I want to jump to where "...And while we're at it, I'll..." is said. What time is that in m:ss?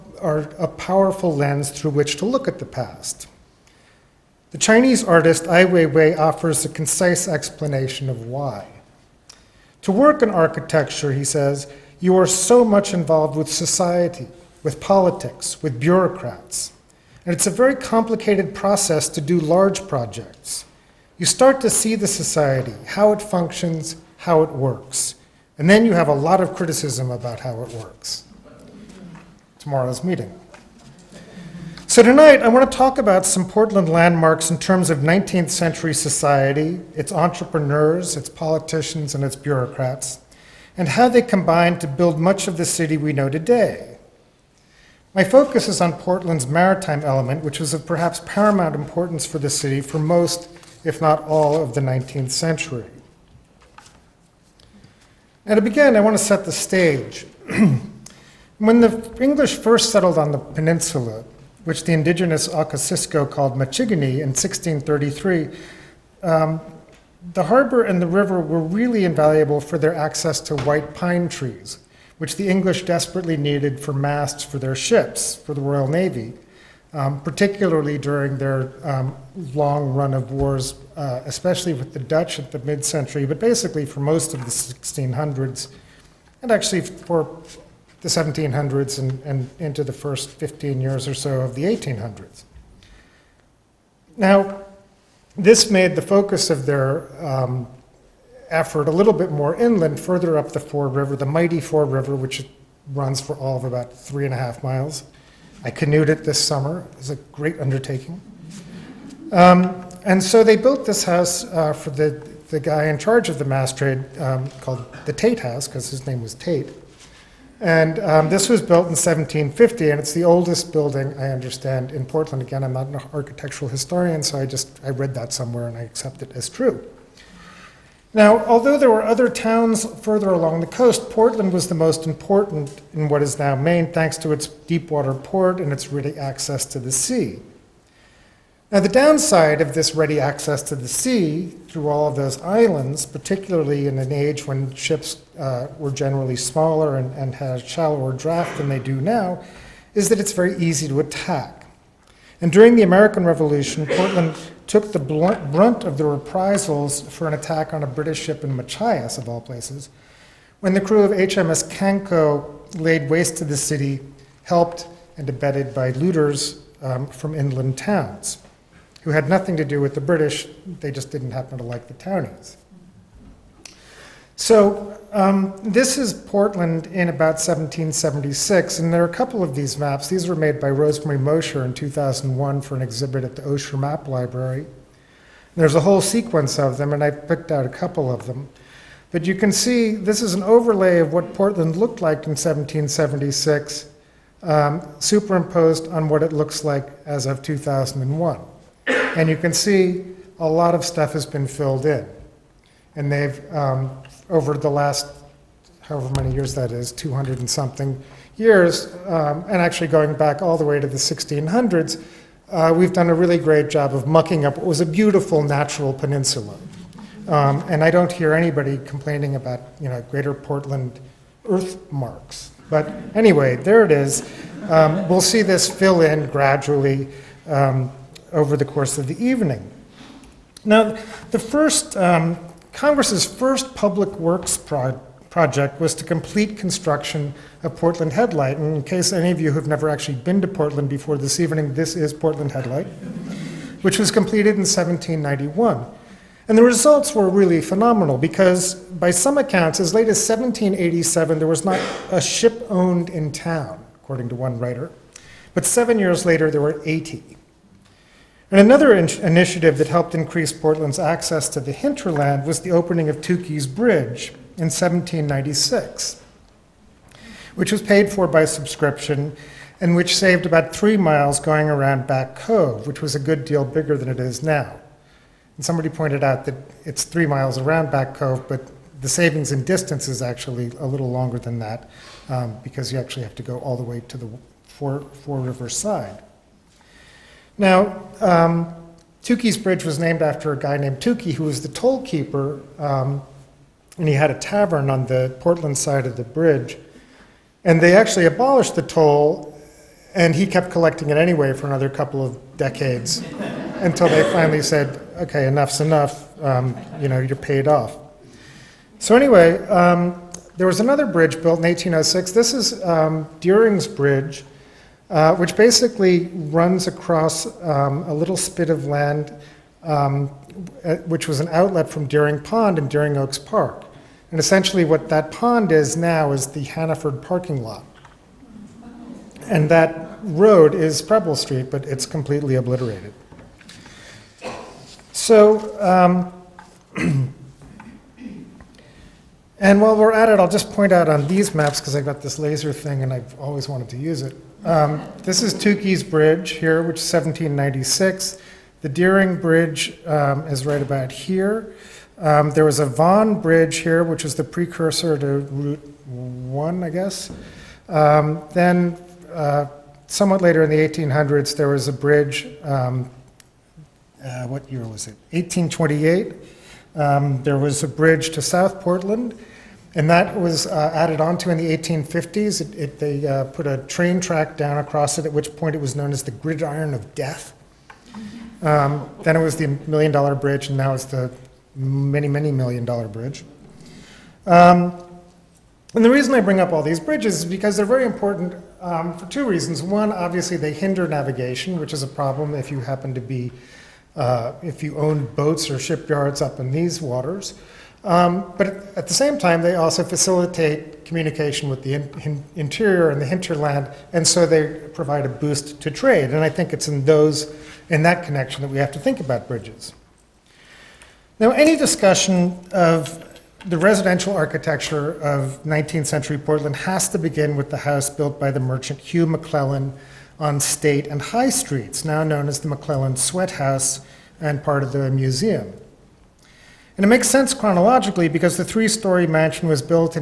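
5:39.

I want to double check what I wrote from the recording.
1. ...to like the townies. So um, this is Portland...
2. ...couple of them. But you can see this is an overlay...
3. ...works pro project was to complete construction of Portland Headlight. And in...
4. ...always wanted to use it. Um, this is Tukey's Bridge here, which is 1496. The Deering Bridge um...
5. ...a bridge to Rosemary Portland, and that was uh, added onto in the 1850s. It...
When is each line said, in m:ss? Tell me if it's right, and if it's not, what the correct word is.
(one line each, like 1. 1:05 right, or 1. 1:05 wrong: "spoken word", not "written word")
1. 2:51 right
2. 3:07 right
3. 3:54 right
4. 5:43 wrong: "1796", not "1496"
5. 6:07 wrong: "South", not "Rosemary".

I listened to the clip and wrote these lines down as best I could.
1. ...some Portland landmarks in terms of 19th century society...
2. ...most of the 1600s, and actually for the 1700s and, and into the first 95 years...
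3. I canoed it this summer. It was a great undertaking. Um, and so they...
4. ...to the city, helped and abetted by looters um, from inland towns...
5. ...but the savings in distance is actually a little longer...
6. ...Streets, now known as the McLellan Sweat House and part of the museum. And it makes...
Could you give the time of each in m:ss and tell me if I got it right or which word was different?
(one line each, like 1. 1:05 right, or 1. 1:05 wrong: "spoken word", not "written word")
1. 0:33 right
2. 1:23 wrong: "15", not "95"
3. 1:45 right
4. 2:43 right
5. 4:38 right
6. 7:01 right.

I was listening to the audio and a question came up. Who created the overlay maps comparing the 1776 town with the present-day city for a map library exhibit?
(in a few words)
Rosemary Mosher.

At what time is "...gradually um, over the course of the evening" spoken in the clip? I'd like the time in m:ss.
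3:46.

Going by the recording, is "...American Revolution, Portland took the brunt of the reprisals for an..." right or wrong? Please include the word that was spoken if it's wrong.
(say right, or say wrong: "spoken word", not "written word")
right.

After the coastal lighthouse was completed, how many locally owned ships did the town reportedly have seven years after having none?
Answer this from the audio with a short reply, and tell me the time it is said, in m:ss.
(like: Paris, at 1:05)
80, at 4:16.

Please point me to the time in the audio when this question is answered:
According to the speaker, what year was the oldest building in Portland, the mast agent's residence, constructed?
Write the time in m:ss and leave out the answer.
1:58.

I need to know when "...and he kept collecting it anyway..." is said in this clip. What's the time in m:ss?
5:00.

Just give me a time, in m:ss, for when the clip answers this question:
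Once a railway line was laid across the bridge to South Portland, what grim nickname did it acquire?
6:16.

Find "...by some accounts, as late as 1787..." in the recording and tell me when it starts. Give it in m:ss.
4:08.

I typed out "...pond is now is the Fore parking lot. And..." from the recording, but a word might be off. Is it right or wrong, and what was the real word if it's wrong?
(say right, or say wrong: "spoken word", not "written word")
wrong: "Hannaford", not "Fore".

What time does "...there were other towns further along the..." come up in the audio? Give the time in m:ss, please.
2:08.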